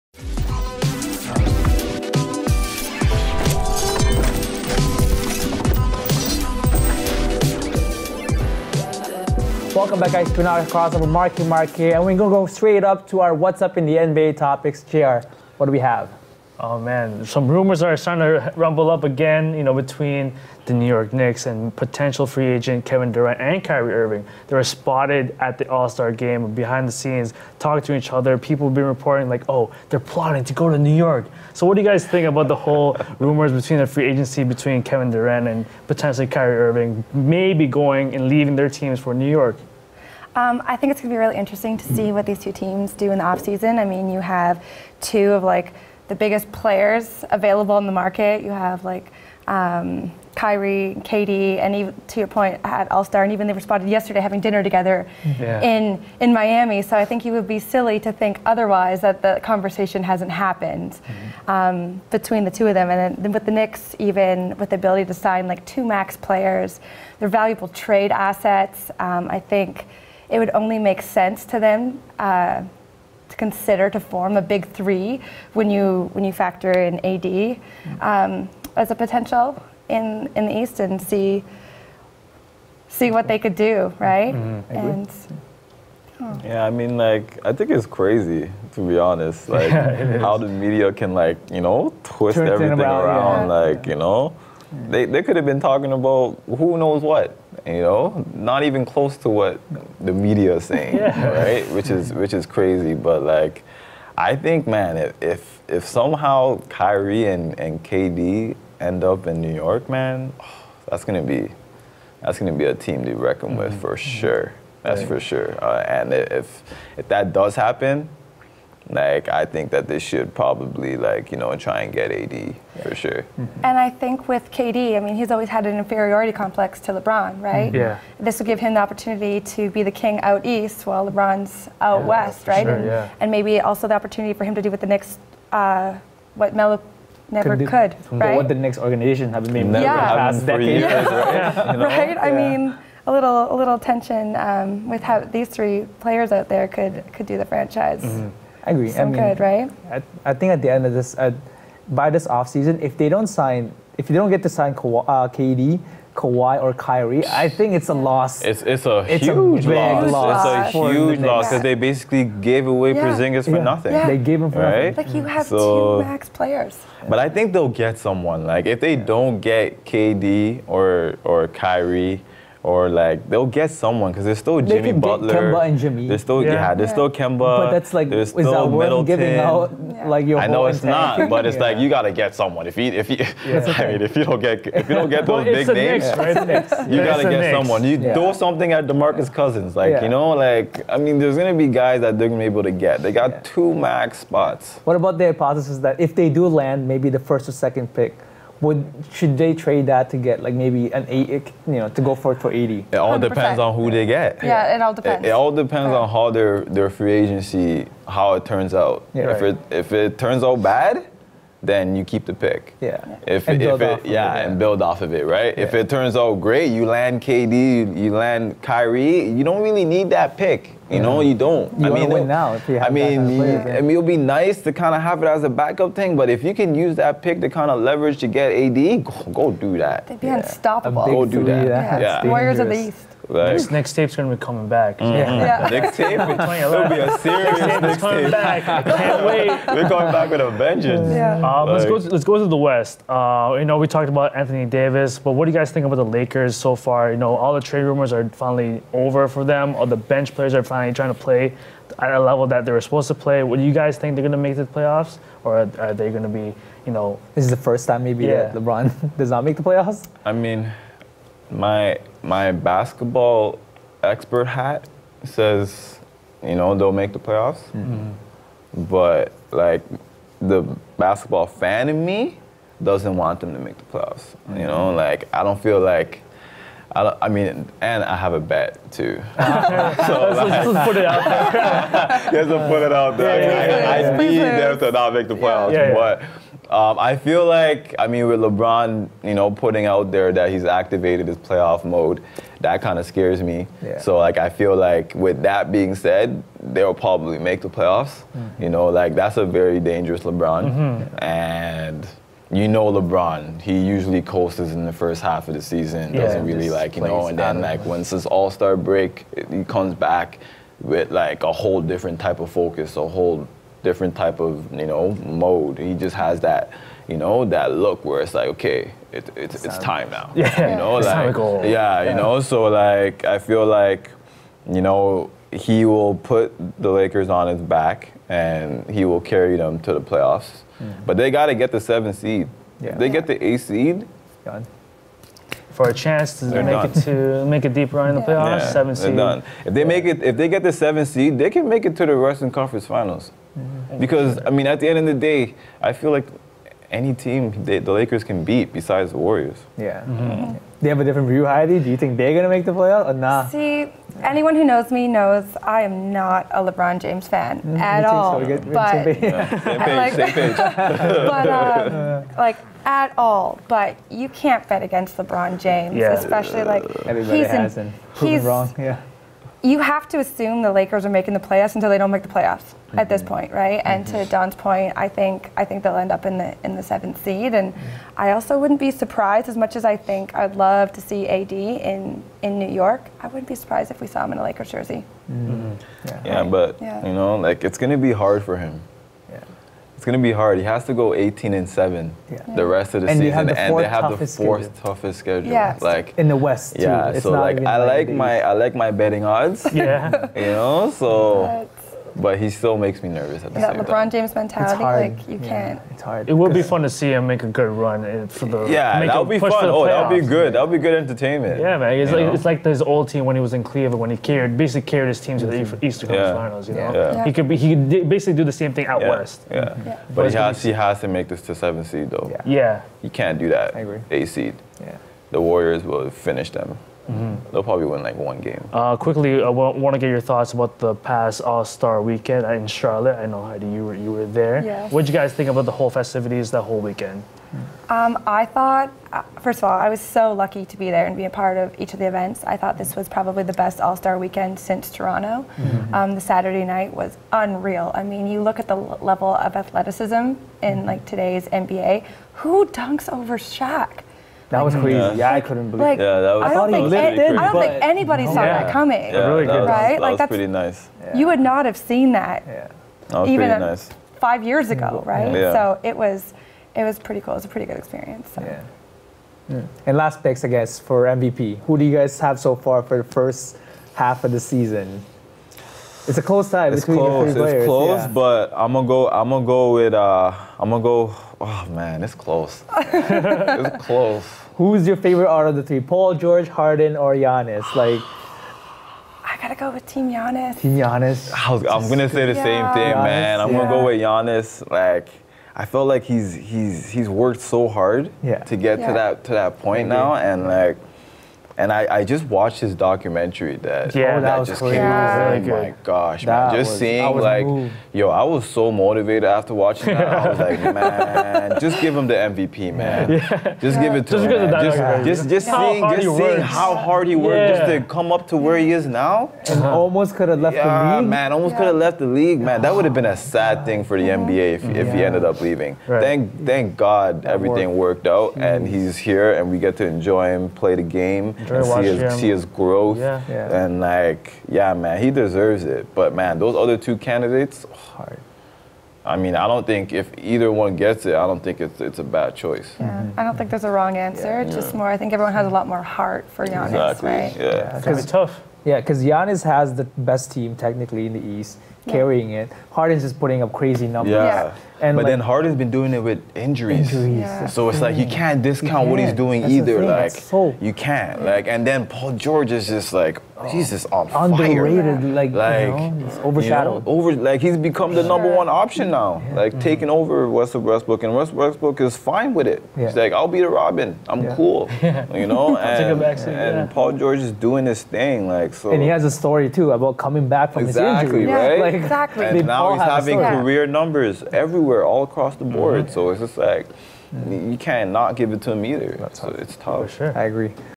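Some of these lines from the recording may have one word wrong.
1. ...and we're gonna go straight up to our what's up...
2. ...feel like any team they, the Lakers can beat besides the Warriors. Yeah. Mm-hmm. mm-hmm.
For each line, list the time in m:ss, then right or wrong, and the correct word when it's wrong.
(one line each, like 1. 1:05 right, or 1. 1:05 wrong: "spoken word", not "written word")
1. 0:11 right
2. 5:45 right.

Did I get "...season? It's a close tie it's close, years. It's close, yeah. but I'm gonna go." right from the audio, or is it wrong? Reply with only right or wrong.
wrong.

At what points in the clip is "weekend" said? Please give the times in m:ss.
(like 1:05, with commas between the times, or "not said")
7:12, 7:16, 7:24.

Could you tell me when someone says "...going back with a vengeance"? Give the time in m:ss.
3:59.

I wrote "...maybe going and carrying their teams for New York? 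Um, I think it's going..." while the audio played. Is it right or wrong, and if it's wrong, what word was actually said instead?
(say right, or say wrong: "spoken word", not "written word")
wrong: "leaving", not "carrying".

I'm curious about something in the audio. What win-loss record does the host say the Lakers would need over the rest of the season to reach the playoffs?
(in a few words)
18 and 7.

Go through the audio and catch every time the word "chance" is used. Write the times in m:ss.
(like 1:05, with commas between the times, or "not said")
5:35.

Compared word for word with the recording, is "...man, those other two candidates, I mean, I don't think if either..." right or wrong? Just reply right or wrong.
right.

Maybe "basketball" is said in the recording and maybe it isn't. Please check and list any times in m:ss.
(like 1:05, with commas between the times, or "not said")
4:22, 4:30.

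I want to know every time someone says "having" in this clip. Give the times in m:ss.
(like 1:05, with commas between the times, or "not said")
0:54, 9:42.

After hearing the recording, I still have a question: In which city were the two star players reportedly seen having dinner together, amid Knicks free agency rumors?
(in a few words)
Miami.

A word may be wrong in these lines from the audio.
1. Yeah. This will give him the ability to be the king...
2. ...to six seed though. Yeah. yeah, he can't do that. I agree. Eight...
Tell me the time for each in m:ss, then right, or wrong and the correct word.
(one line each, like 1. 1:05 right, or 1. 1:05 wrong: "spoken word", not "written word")
1. 2:07 wrong: "opportunity", not "ability"
2. 7:01 wrong: "seven", not "six".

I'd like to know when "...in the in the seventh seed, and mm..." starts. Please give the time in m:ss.
6:16.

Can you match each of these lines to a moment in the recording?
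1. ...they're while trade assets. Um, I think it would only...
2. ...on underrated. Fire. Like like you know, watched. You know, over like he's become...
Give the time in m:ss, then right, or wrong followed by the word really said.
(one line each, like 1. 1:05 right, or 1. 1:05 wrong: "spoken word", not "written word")
1. 1:07 wrong: "valuable", not "while"
2. 9:23 wrong: "overshadowed", not "watched".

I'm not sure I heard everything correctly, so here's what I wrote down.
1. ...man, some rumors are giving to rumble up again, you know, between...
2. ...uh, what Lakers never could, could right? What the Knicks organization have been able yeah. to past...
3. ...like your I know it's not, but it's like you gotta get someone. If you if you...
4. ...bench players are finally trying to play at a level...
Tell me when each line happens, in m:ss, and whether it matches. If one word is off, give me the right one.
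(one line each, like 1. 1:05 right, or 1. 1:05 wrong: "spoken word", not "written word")
1. 0:16 wrong: "starting", not "giving"
2. 2:15 wrong: "Melo", not "Lakers"
3. 3:00 right
4. 4:09 right.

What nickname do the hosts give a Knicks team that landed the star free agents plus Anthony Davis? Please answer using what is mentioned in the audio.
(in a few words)
Warriors of the East.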